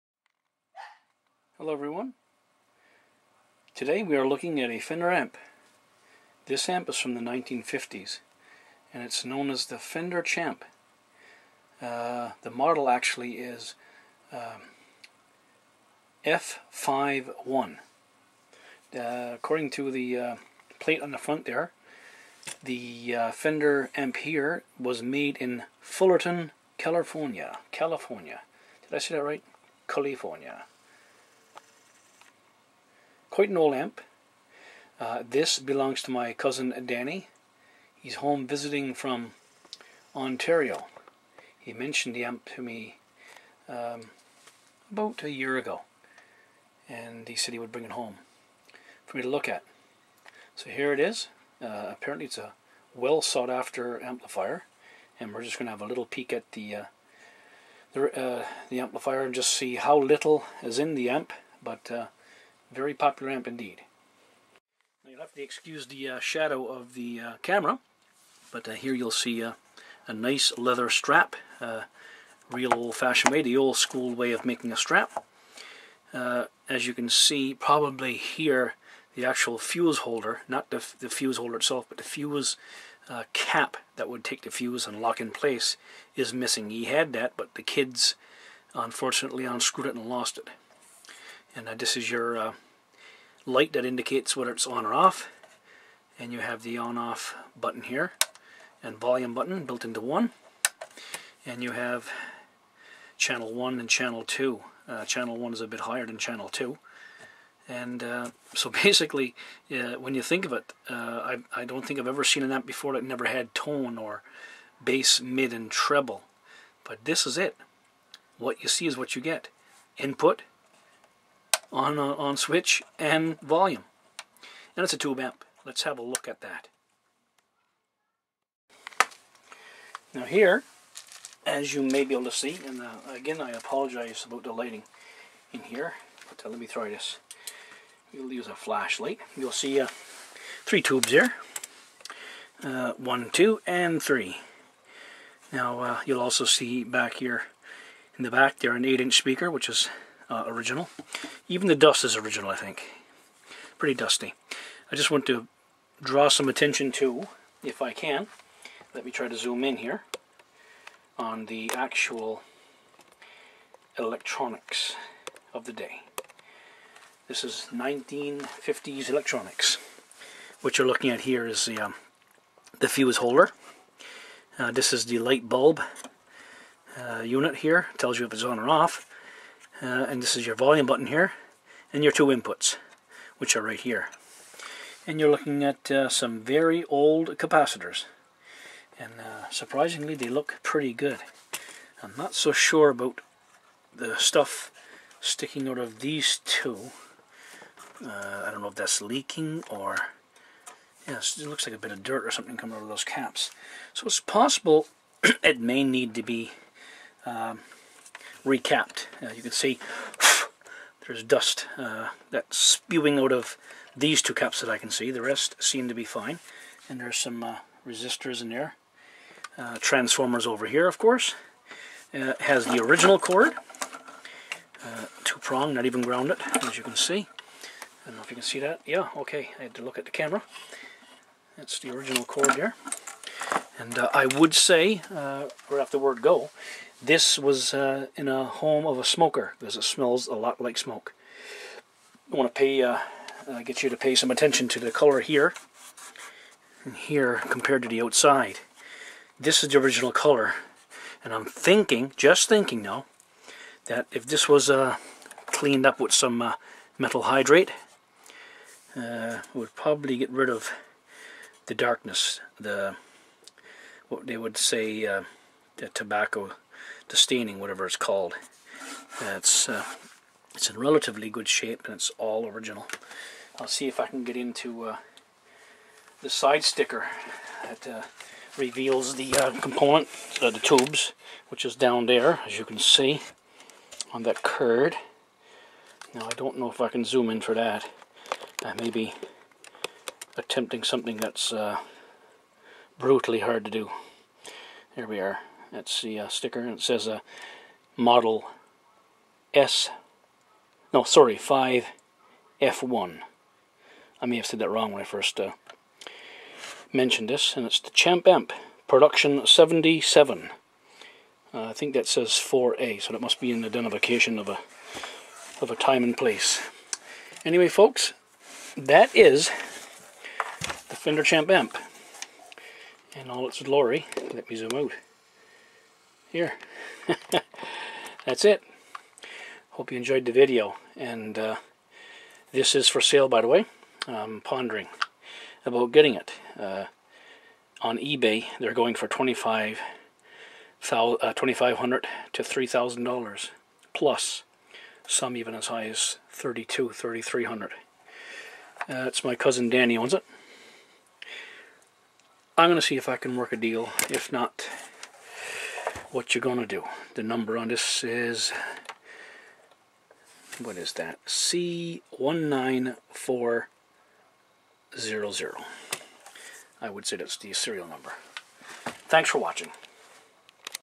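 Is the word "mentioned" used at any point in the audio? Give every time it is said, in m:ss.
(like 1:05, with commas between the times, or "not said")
0:41, 5:06.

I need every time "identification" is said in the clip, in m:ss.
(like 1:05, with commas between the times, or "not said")
5:13.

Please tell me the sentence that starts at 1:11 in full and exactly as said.
Uh, real old-fashioned way, the old school way of making a strap.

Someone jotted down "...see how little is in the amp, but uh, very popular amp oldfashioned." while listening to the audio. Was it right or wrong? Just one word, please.
wrong.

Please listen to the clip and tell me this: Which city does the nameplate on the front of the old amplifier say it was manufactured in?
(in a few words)
Fullerton.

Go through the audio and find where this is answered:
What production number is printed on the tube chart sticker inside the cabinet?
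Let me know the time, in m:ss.
5:09.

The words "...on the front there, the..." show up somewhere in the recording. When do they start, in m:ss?
0:21.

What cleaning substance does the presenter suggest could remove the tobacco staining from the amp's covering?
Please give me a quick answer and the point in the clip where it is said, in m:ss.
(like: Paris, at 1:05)
methyl hydrate, at 4:16.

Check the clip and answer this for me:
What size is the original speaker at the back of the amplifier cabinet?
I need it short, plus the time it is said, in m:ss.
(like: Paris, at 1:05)
8-inch, at 2:28.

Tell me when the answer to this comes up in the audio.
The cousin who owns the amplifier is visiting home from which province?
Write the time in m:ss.
0:40.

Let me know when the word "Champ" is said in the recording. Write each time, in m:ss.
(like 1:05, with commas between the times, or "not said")
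0:10, 5:07, 5:21.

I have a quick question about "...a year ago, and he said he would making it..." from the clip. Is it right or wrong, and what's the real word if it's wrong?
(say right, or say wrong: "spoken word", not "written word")
wrong: "bring", not "making".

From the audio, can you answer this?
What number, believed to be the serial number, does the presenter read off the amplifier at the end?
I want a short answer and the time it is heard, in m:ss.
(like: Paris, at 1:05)
C19400, at 6:01.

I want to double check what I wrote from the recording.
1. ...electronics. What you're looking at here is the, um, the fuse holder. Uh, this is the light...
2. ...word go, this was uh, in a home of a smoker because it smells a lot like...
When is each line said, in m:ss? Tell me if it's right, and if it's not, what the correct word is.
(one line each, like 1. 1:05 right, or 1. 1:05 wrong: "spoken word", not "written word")
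1. 2:49 right
2. 3:55 right.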